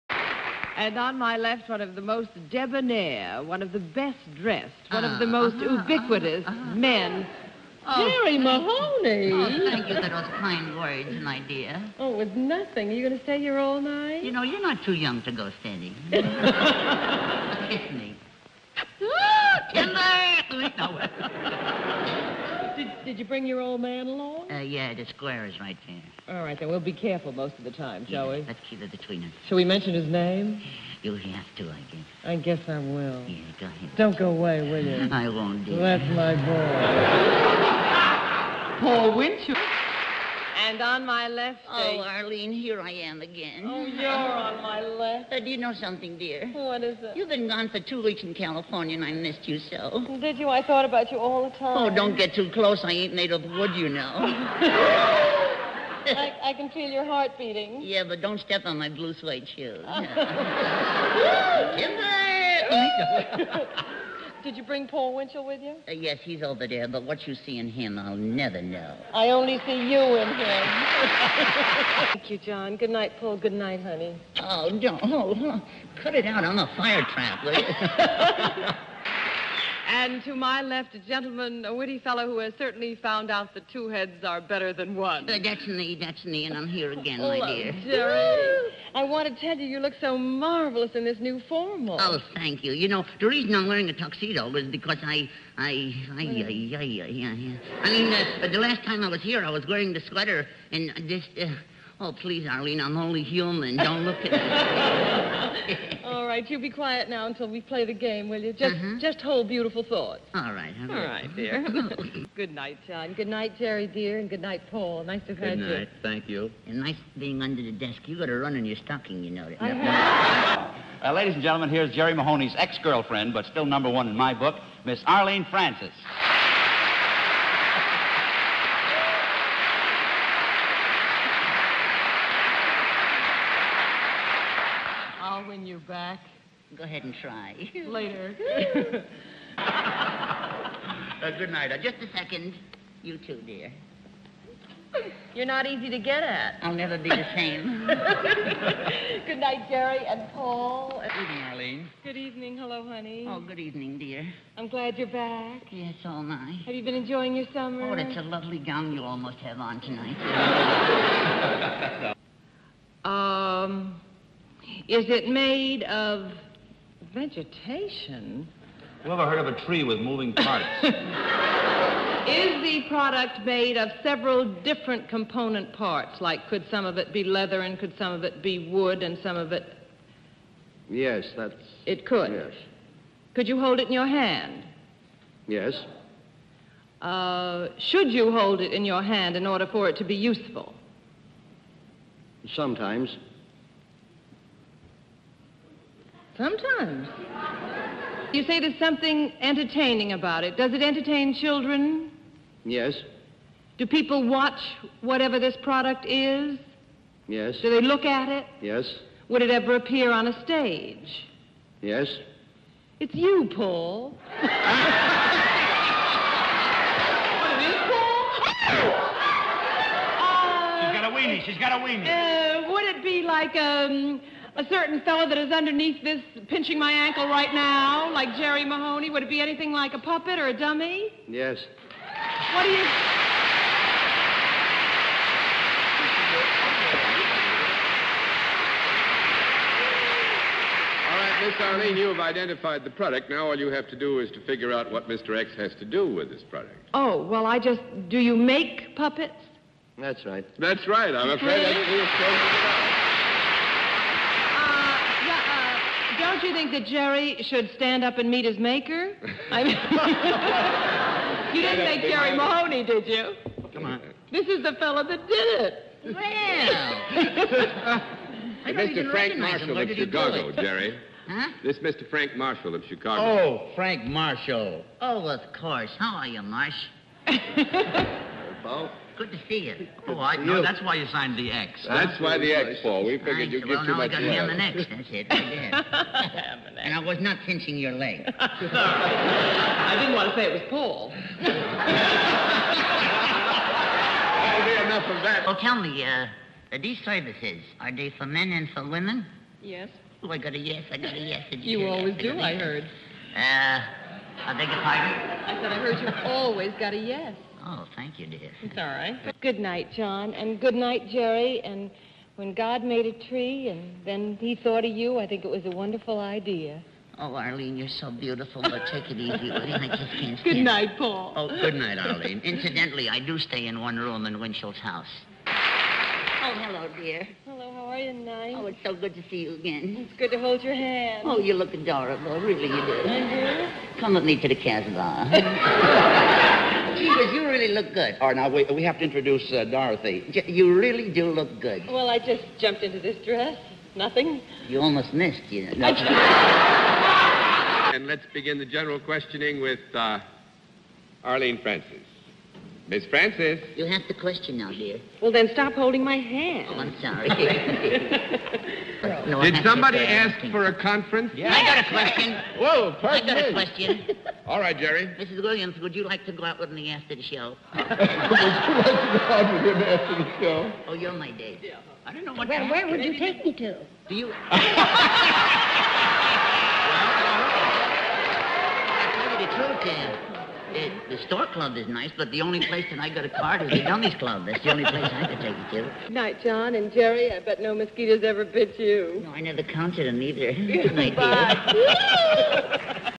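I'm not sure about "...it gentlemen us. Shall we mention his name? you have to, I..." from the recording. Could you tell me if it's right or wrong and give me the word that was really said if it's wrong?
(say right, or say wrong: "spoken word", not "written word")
wrong: "between", not "gentlemen".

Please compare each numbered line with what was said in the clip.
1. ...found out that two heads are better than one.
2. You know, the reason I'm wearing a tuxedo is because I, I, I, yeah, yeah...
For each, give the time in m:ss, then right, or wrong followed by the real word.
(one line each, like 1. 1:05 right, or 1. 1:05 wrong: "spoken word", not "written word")
1. 1:22 right
2. 1:32 right.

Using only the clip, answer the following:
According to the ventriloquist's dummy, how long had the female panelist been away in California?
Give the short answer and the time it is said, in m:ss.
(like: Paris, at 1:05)
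2 weeks, at 0:47.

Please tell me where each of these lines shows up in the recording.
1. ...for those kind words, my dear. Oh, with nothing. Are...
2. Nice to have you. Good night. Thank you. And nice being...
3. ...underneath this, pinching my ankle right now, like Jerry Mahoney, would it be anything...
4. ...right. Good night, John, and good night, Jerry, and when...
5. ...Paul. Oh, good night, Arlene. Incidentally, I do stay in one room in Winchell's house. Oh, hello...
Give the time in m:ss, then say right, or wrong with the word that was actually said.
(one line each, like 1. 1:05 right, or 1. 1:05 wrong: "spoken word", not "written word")
1. 0:09 right
2. 1:55 right
3. 3:45 right
4. 5:08 right
5. 5:20 right.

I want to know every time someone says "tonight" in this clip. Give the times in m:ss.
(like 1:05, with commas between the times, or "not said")
2:39, 5:28.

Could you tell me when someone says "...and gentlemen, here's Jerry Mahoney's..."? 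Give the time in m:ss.
2:01.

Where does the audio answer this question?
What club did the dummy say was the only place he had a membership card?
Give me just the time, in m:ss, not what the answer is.
6:23.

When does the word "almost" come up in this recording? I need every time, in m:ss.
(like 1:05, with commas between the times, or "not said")
2:39, 5:44.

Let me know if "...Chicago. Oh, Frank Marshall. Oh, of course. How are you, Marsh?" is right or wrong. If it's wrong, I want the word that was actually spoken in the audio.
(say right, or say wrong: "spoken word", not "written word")
right.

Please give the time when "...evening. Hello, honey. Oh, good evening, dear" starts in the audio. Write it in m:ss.
2:32.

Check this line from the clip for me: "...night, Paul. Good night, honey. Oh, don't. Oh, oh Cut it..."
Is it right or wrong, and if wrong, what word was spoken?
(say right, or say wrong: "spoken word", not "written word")
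right.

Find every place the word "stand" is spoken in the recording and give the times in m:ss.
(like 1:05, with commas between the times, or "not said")
4:17, 5:20.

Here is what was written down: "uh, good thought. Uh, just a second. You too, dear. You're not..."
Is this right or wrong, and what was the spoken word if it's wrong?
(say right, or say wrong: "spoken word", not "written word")
wrong: "night", not "thought".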